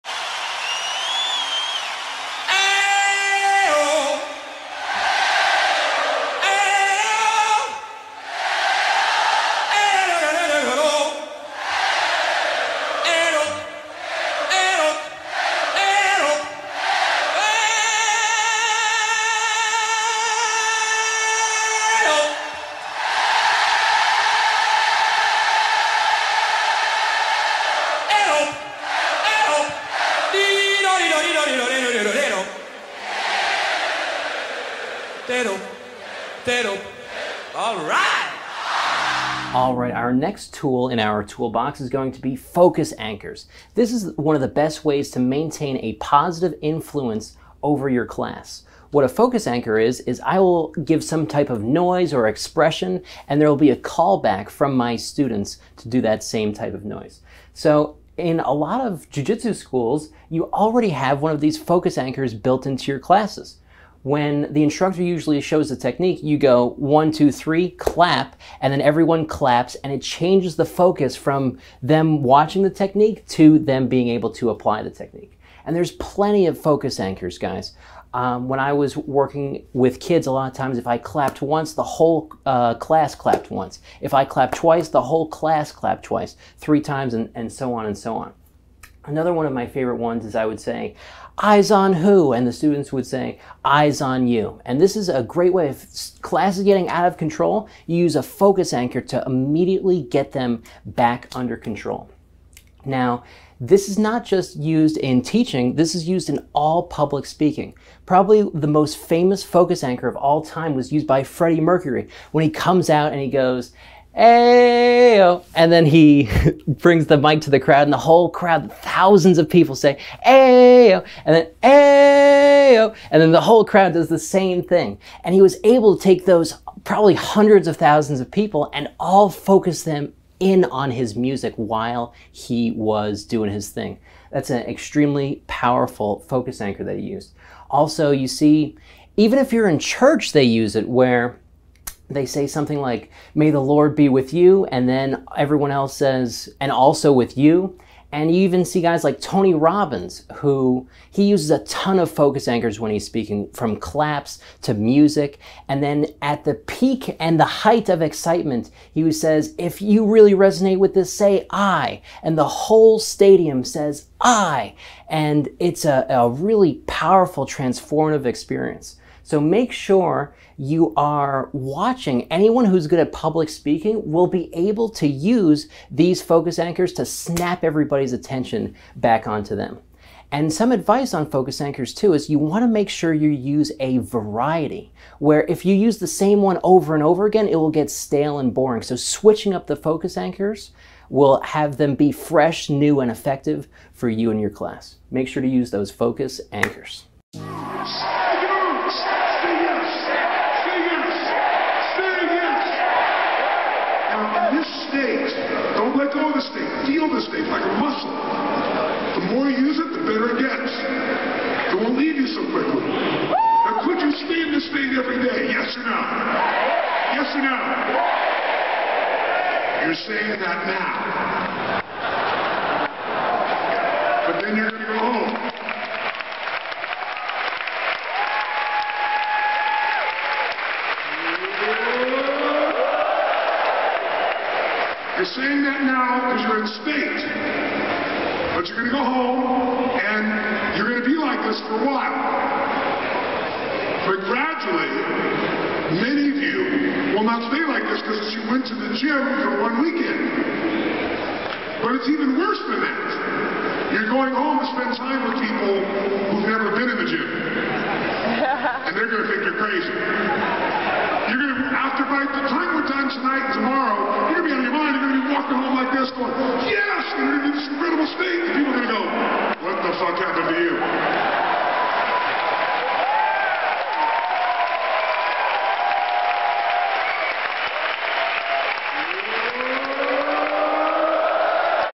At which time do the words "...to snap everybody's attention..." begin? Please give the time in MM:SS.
02:56.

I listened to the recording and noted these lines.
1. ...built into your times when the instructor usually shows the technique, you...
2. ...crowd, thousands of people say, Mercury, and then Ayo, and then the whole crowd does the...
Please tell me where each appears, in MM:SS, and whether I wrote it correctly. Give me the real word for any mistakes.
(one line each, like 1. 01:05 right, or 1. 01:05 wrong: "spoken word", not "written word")
1. 01:02 wrong: "classes", not "times"
2. 01:58 wrong: "Ayo", not "Mercury".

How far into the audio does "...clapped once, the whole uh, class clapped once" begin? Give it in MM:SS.
01:20.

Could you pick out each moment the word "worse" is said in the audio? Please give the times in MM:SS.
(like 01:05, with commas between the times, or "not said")
04:12.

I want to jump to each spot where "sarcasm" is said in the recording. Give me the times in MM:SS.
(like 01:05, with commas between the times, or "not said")
04:30.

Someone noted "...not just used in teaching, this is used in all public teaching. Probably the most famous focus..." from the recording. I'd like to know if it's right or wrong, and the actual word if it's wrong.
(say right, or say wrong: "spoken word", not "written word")
wrong: "speaking", not "teaching".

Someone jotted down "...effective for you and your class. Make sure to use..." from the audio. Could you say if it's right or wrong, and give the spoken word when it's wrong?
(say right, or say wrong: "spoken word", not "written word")
right.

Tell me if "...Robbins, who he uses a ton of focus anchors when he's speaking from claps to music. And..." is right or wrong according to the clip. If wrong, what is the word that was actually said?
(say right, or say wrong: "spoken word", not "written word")
right.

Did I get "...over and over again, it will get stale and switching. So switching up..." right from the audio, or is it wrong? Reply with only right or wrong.
wrong.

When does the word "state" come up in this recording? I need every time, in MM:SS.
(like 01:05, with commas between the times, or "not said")
03:34, 03:56.